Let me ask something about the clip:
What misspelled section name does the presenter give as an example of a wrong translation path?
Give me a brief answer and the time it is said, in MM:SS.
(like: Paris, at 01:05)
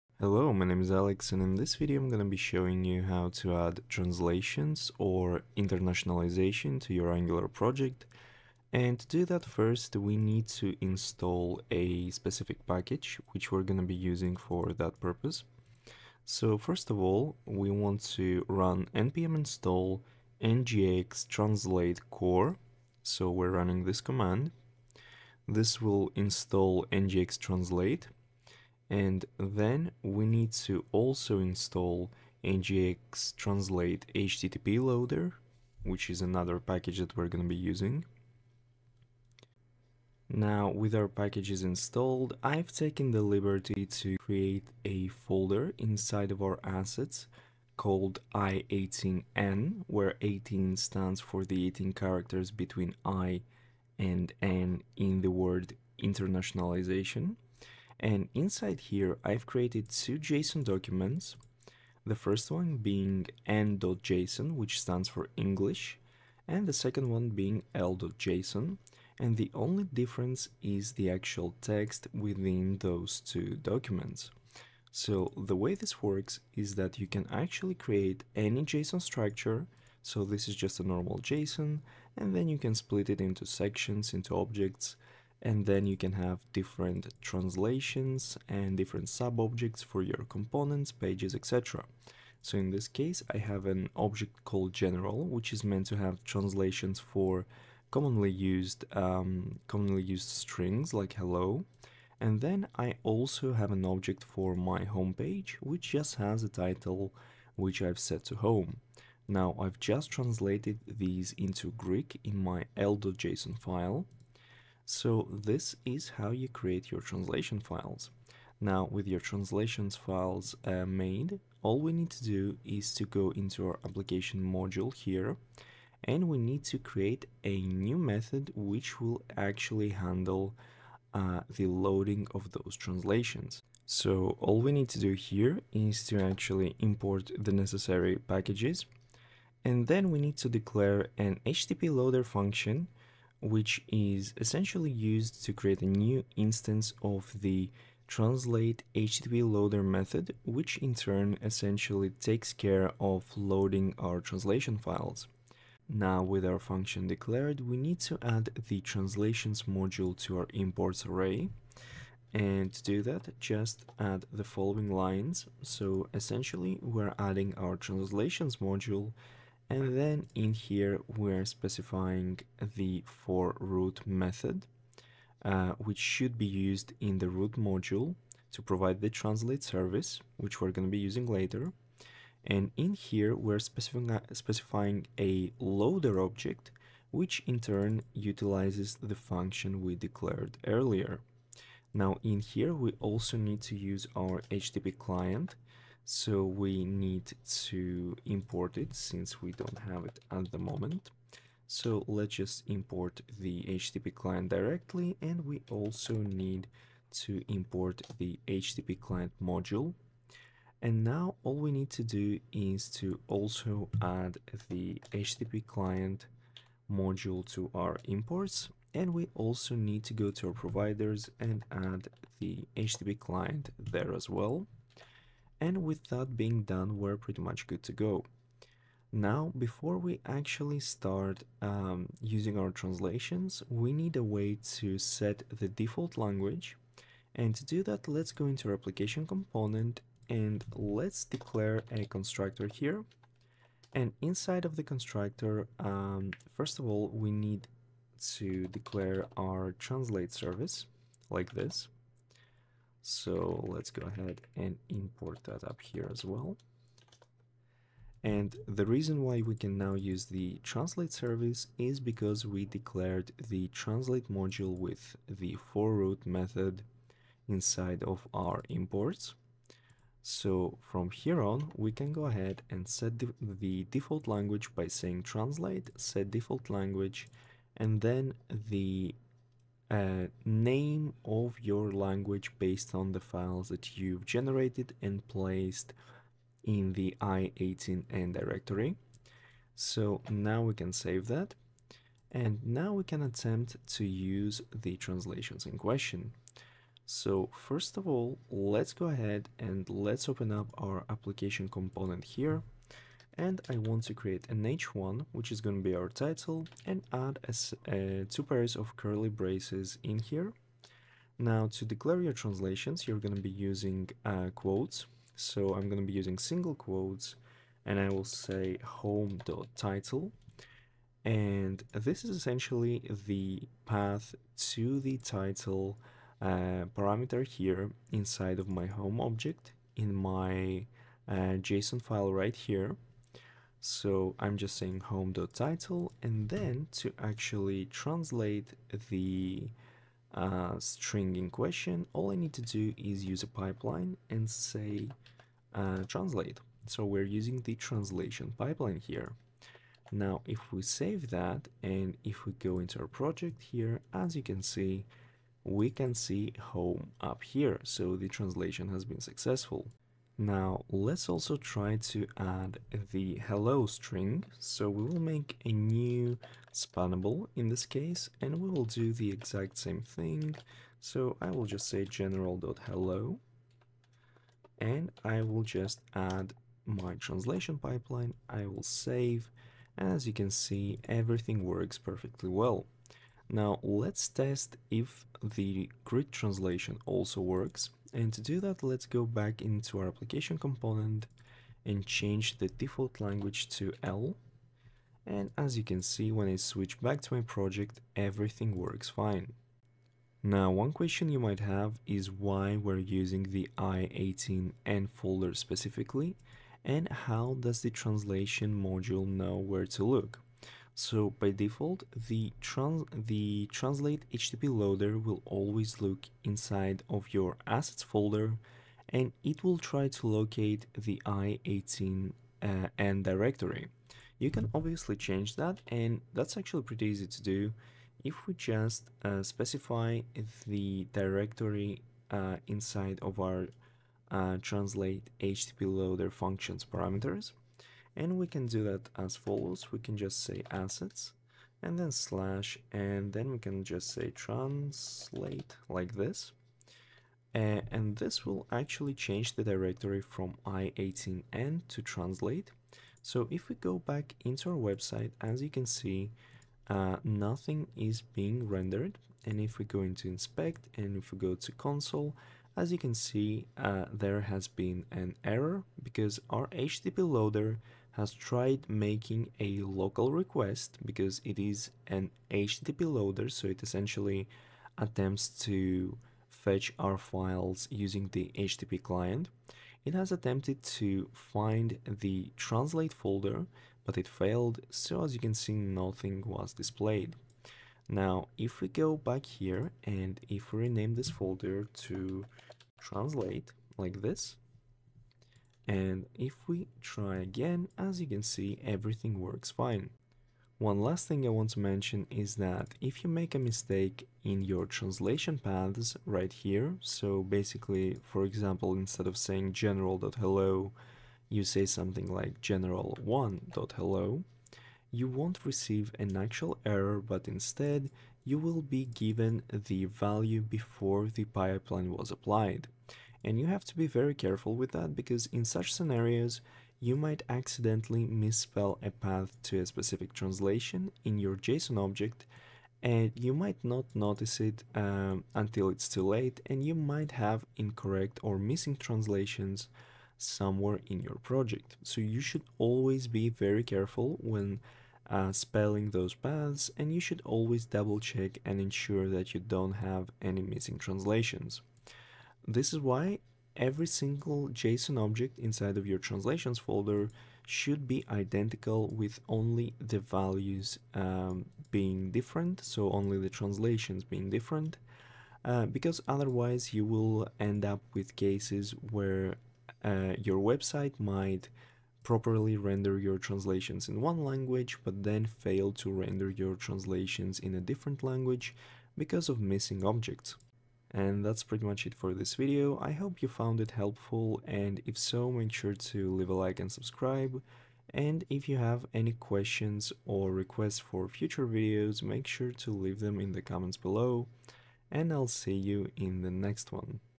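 general1, at 08:32.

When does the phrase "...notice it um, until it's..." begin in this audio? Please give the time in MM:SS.
08:54.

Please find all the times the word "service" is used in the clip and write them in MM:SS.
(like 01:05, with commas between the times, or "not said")
02:59, 04:10, 04:21.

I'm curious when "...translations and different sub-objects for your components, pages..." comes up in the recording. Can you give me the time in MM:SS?
01:27.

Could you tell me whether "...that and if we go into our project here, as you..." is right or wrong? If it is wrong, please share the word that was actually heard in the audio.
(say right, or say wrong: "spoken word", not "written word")
right.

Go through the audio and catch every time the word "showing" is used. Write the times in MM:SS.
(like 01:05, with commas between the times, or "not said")
00:02.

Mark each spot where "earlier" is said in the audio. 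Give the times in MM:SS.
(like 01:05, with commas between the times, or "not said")
03:10.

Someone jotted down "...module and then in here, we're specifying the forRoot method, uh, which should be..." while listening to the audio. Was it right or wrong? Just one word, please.
right.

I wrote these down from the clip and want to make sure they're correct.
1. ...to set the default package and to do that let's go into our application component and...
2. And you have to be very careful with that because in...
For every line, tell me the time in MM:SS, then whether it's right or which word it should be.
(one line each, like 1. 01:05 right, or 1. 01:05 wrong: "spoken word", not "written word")
1. 03:54 wrong: "language", not "package"
2. 08:43 right.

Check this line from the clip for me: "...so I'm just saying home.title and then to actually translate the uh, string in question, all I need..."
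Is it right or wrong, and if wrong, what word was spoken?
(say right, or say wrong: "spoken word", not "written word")
right.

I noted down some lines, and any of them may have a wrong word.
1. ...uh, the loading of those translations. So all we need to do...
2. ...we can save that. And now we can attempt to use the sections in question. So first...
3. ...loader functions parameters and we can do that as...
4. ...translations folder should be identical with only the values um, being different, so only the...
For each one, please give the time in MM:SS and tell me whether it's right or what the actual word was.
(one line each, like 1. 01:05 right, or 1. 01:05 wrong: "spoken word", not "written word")
1. 02:11 right
2. 04:50 wrong: "translations", not "sections"
3. 07:15 right
4. 09:16 right.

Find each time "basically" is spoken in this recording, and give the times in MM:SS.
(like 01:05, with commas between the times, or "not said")
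08:27.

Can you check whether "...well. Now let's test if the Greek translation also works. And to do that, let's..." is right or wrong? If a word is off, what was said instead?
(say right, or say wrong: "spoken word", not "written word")
right.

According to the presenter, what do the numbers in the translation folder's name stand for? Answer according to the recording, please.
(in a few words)
18 characters.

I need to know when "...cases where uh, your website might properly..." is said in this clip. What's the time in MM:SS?
09:28.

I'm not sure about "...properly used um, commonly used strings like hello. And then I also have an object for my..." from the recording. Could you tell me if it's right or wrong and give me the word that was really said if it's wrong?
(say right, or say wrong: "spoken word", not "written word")
wrong: "commonly", not "properly".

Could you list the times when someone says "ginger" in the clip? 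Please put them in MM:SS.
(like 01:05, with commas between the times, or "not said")
not said.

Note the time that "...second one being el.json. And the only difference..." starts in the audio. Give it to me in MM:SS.
01:06.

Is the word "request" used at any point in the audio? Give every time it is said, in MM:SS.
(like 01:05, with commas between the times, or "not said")
07:50, 09:50.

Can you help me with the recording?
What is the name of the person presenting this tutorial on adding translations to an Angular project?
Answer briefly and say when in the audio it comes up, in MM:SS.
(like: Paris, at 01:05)
Alex, at 00:00.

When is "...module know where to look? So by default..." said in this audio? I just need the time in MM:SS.
06:48.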